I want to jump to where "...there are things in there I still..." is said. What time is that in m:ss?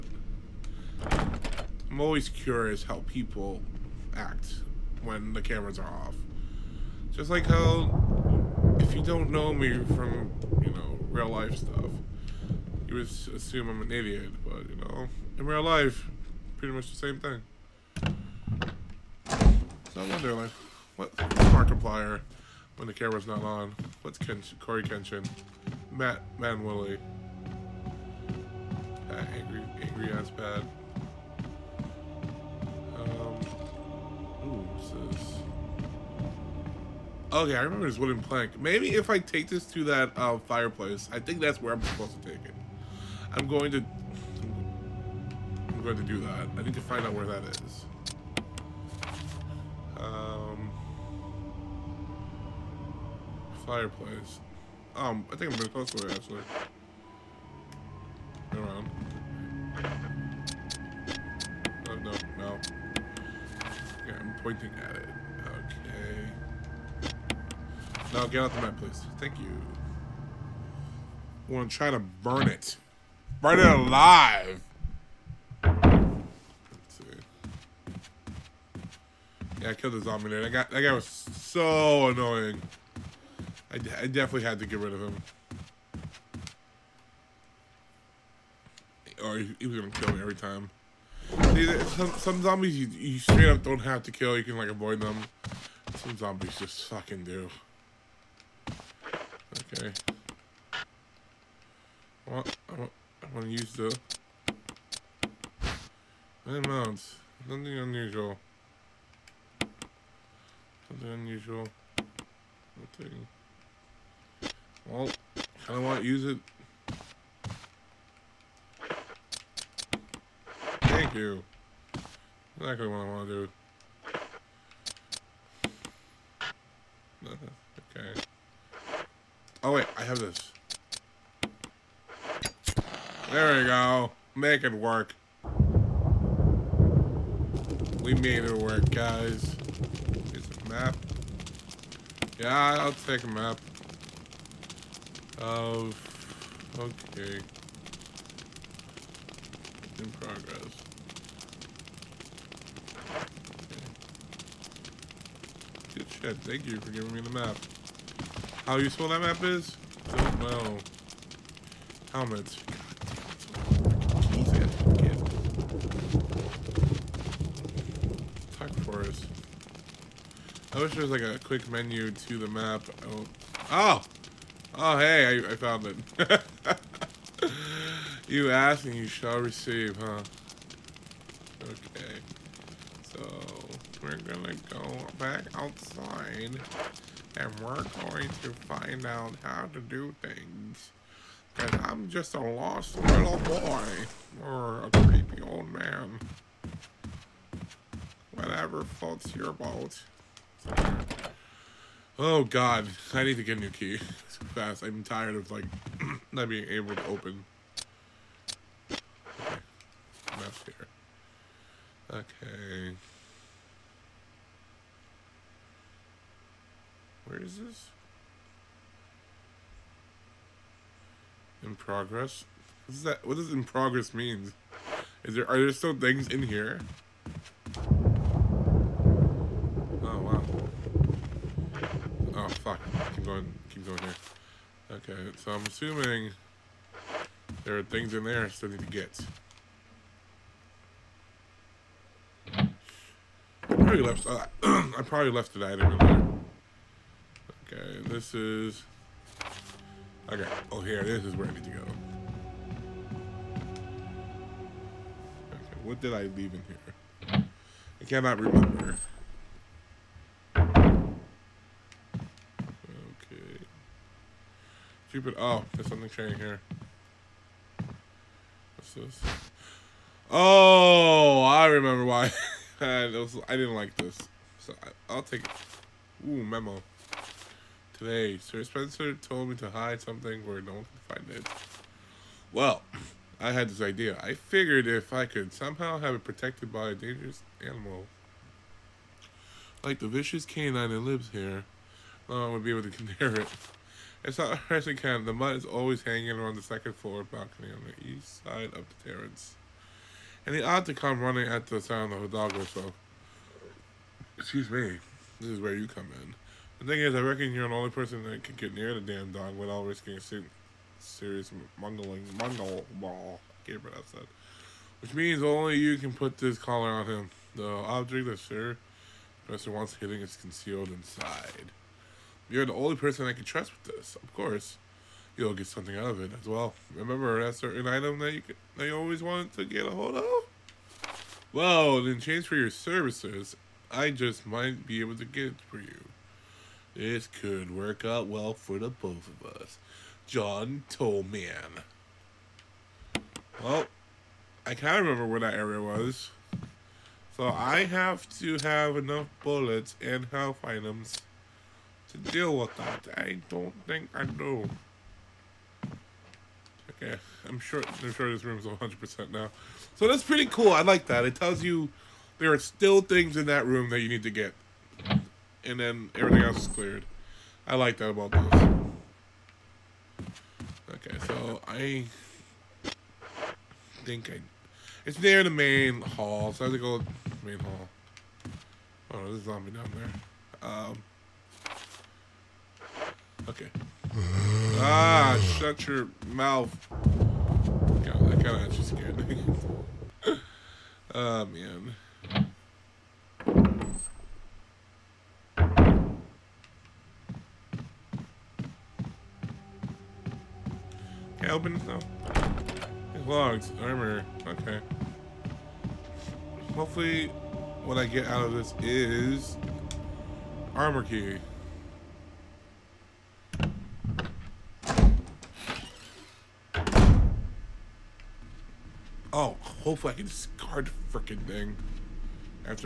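3:57.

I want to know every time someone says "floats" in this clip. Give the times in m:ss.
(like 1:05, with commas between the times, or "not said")
3:18.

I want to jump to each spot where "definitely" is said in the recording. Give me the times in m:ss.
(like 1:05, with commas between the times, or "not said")
1:23.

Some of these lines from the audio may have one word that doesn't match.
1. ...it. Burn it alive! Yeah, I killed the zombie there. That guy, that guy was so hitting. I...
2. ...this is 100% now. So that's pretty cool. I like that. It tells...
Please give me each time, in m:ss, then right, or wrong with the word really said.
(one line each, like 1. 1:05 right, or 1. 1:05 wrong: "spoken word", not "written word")
1. 1:12 wrong: "annoying", not "hitting"
2. 5:58 right.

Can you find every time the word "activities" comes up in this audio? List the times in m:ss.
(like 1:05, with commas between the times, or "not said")
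not said.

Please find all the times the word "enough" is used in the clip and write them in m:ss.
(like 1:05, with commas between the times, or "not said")
3:30, 5:48.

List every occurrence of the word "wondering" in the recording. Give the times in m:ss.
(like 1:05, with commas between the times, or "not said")
0:20.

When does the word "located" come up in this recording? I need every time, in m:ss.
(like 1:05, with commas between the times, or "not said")
not said.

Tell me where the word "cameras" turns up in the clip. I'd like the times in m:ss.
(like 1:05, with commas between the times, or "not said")
0:05, 0:22.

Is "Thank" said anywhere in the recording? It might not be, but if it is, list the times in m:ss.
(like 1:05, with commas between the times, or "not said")
1:09, 2:36.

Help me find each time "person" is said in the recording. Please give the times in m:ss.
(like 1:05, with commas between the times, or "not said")
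5:07, 5:22.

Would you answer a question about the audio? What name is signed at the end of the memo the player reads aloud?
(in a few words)
John Tollman.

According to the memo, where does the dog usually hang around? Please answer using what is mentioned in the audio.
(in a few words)
Second floor balcony.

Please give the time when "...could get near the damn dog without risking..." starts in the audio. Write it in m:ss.
5:08.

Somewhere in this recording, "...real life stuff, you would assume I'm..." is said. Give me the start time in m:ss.
0:11.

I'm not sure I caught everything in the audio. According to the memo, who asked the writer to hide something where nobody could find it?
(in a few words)
Sir Spencer.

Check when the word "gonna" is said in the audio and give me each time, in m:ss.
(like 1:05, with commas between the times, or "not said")
1:29, 3:04.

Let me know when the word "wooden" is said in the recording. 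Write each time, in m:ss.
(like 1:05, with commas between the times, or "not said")
0:37.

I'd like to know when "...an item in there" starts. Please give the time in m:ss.
4:05.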